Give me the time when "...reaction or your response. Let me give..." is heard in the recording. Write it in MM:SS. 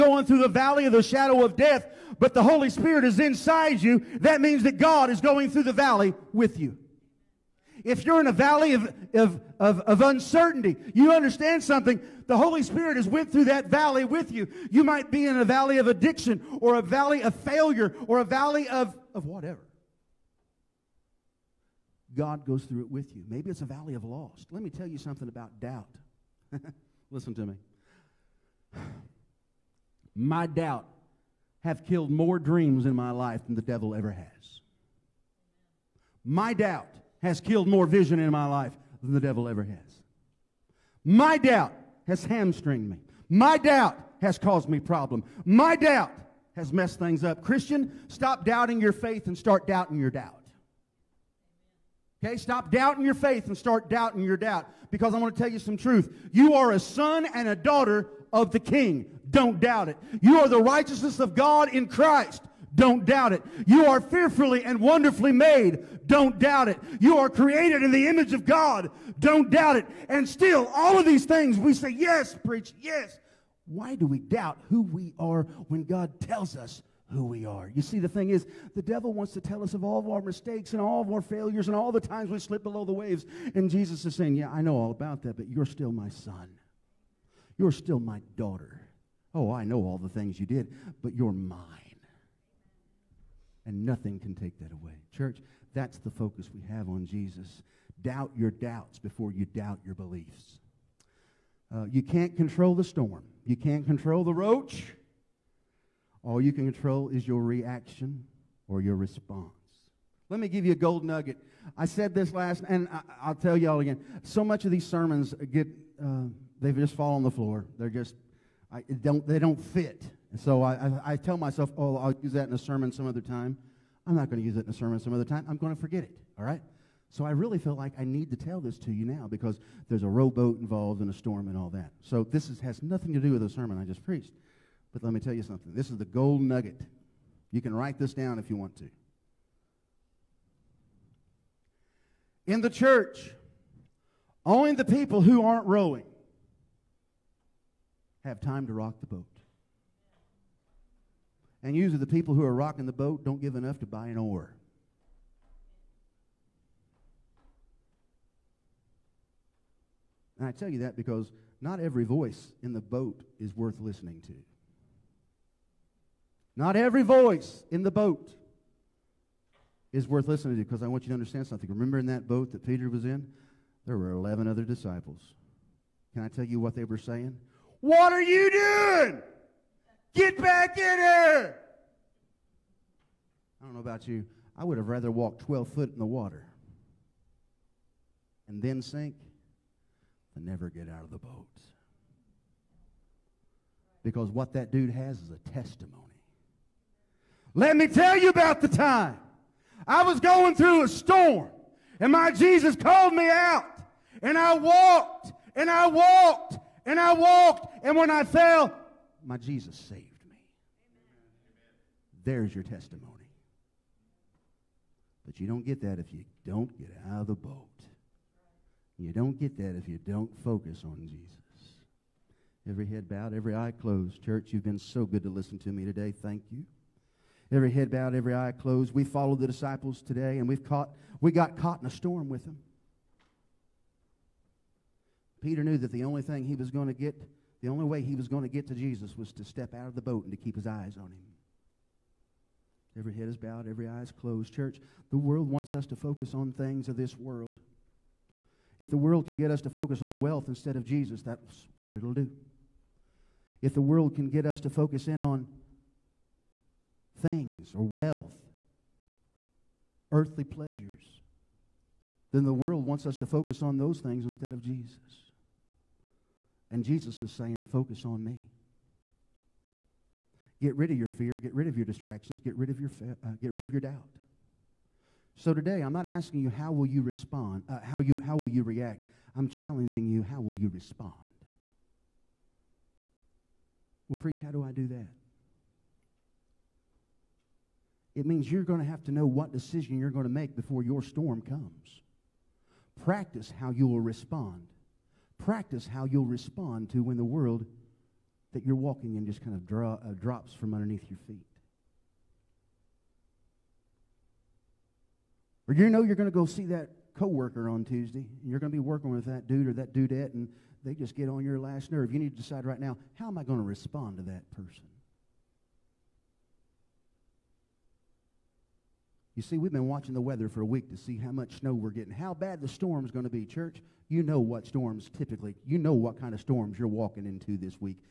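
01:47.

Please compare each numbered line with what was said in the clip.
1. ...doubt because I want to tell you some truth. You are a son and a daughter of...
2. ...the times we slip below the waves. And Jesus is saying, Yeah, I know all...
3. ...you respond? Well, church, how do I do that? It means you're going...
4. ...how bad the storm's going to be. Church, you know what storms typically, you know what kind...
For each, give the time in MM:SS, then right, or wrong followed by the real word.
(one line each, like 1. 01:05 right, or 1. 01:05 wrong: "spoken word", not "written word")
1. 00:54 right
2. 01:21 right
3. 04:40 wrong: "preach", not "church"
4. 05:22 right.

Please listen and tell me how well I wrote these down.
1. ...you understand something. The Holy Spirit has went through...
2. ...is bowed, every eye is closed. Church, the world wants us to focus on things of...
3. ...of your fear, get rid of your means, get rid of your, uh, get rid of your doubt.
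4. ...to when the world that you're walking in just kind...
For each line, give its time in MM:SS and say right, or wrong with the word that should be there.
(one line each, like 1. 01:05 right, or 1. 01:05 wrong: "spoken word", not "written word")
1. 00:10 right
2. 04:03 right
3. 04:30 wrong: "distractions", not "means"
4. 04:56 right.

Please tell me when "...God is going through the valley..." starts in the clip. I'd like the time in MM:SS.
00:04.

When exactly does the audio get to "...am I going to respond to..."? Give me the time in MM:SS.
05:13.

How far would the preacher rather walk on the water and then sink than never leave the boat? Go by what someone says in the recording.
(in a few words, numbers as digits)
12 foot.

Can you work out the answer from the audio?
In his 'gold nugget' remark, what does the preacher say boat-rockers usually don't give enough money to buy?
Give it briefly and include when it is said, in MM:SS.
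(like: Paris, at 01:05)
an oar, at 02:34.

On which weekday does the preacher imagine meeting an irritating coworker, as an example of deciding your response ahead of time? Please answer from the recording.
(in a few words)
Tuesday.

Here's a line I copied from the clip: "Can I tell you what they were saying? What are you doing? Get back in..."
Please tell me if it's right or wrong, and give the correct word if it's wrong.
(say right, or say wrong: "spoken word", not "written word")
right.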